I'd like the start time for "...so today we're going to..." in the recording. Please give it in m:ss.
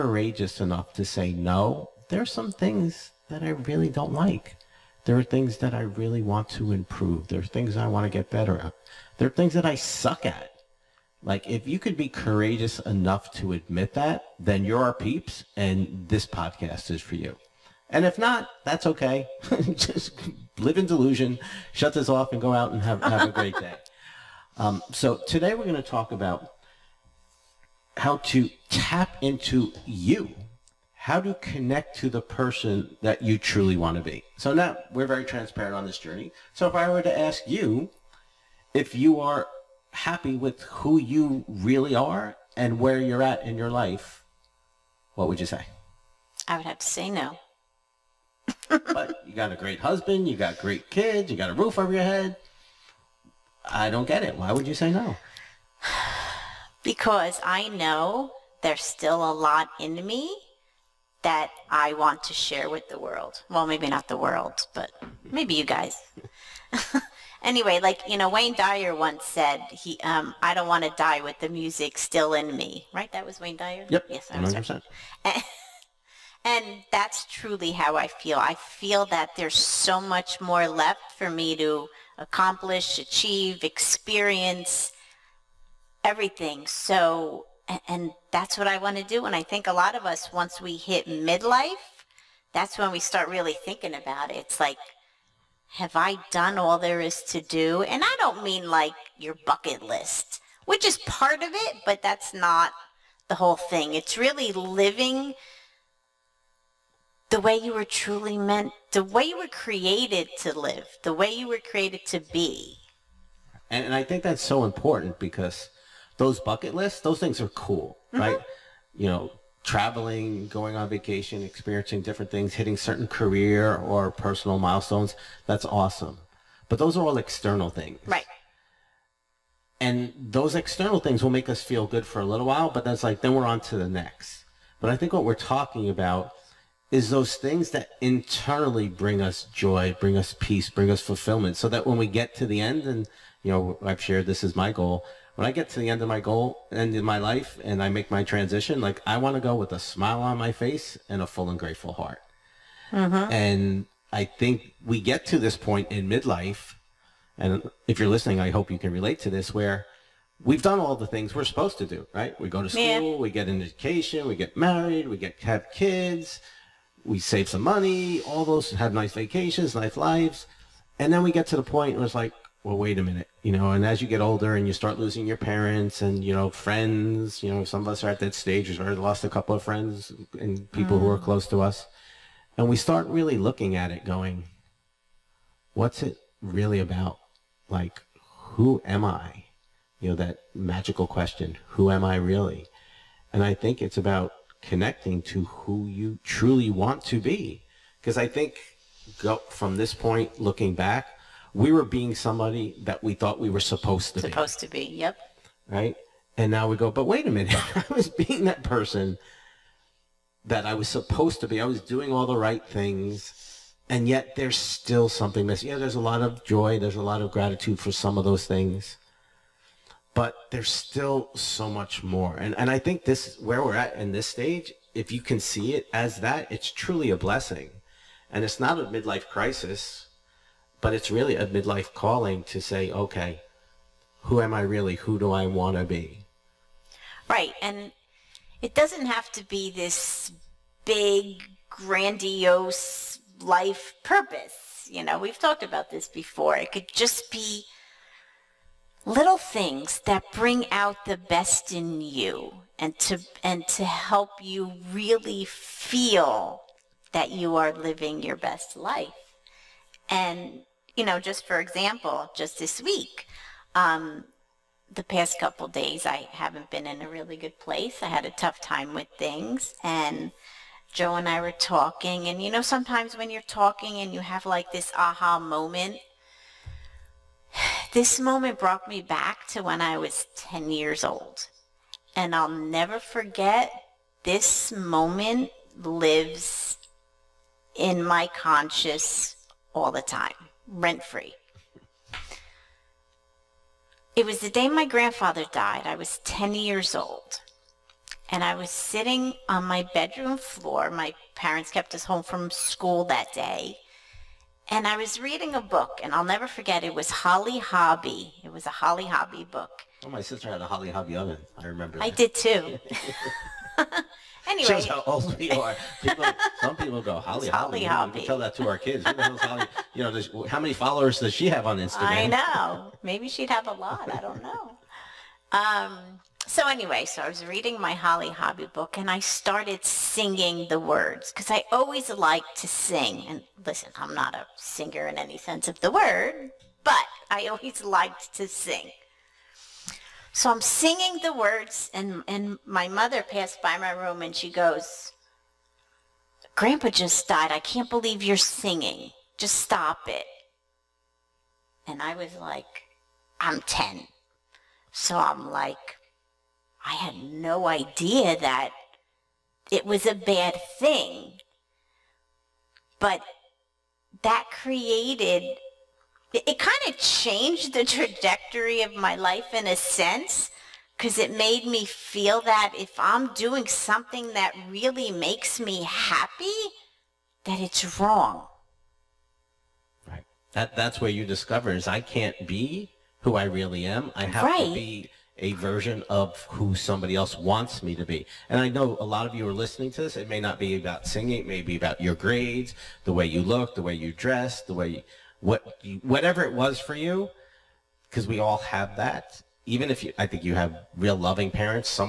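0:24.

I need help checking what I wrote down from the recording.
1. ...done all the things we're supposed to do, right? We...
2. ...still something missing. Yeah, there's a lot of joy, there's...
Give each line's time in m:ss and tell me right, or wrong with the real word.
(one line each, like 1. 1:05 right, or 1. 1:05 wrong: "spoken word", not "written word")
1. 2:40 right
2. 3:34 right.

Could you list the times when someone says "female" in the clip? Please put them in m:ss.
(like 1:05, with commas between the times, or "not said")
not said.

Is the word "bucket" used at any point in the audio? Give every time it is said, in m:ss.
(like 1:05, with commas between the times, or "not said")
1:39, 1:56.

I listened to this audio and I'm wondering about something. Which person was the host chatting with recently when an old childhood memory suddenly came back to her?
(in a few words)
Joe.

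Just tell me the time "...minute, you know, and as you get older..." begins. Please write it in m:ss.
2:53.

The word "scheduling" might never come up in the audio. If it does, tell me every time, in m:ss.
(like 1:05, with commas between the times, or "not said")
not said.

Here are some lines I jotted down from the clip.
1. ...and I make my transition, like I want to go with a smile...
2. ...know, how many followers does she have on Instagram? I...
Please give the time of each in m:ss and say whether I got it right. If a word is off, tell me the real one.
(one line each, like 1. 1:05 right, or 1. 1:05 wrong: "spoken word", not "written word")
1. 2:27 right
2. 5:20 right.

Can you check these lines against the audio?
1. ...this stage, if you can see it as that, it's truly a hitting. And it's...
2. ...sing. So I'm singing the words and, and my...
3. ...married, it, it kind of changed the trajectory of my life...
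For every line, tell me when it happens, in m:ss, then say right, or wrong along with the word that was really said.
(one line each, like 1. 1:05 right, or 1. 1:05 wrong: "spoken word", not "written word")
1. 3:44 wrong: "blessing", not "hitting"
2. 5:38 right
3. 6:04 wrong: "created", not "married".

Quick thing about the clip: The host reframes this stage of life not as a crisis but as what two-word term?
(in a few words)
midlife calling.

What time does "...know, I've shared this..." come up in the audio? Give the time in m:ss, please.
2:23.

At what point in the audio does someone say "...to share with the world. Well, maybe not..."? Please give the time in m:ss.
1:02.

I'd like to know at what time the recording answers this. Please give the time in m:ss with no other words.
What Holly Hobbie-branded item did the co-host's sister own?
5:11.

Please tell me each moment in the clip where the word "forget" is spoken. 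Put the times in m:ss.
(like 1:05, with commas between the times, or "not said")
4:42, 5:06.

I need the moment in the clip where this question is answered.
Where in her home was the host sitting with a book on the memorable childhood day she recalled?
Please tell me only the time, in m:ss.
4:59.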